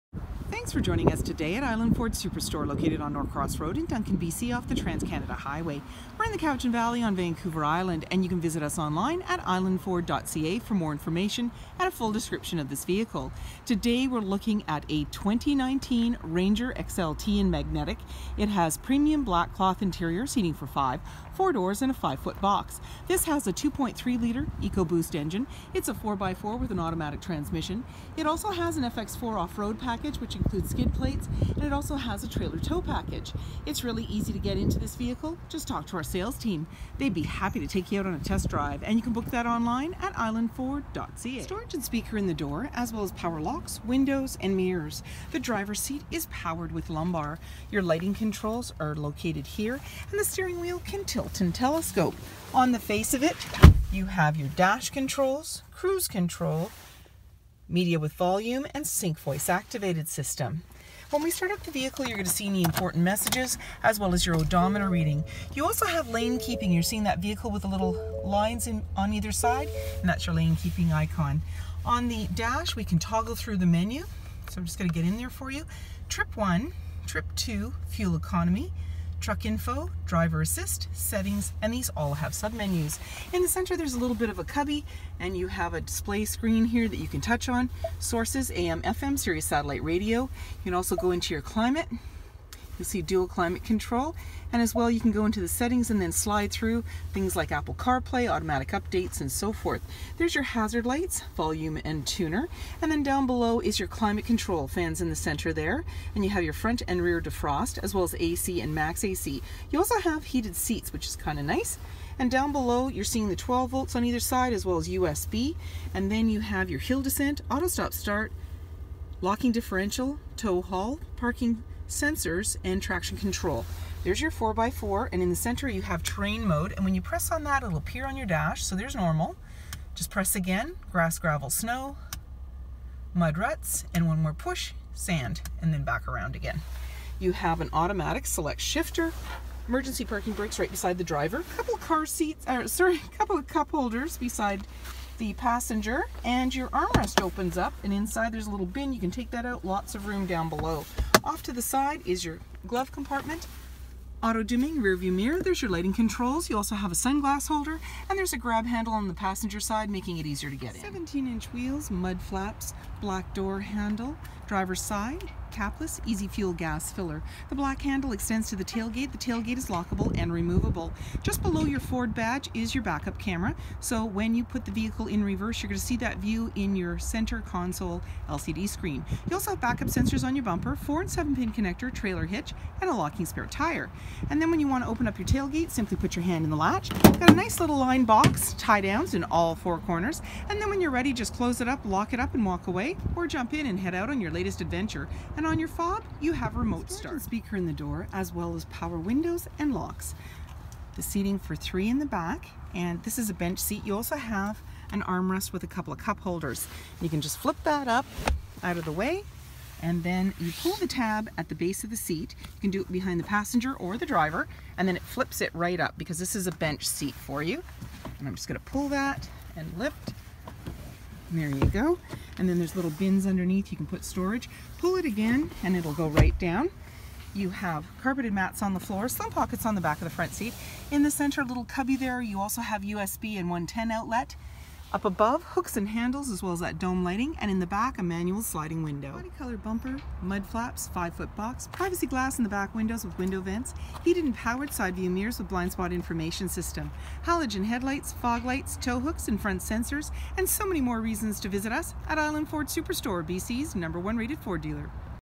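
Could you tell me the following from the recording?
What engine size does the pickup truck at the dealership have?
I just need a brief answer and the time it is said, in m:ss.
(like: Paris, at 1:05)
2.3 litre, at 0:23.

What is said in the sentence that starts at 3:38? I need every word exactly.
And I'm just gonna pull that and lift.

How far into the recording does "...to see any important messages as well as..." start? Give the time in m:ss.
1:02.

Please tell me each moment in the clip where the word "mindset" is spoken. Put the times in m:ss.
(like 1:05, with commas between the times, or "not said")
not said.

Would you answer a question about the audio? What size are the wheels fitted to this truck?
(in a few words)
17 inch.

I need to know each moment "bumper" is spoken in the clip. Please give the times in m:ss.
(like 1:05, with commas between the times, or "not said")
3:00, 3:59.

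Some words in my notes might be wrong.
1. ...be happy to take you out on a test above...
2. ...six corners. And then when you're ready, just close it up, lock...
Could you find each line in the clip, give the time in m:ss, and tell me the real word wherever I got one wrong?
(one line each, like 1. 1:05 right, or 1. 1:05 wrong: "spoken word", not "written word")
1. 0:37 wrong: "drive", not "above"
2. 3:09 wrong: "four", not "six".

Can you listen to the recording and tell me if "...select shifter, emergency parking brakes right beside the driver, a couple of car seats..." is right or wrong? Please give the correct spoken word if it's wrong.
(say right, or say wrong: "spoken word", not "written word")
right.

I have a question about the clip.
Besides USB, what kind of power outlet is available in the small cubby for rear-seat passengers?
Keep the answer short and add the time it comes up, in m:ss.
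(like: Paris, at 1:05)
110 outlet, at 3:53.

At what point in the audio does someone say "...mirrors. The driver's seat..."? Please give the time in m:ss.
0:44.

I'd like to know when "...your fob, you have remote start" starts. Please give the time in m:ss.
3:15.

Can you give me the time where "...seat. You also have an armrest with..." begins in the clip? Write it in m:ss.
3:23.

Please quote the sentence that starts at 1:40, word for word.
There's your hazard lights, volume and tuner.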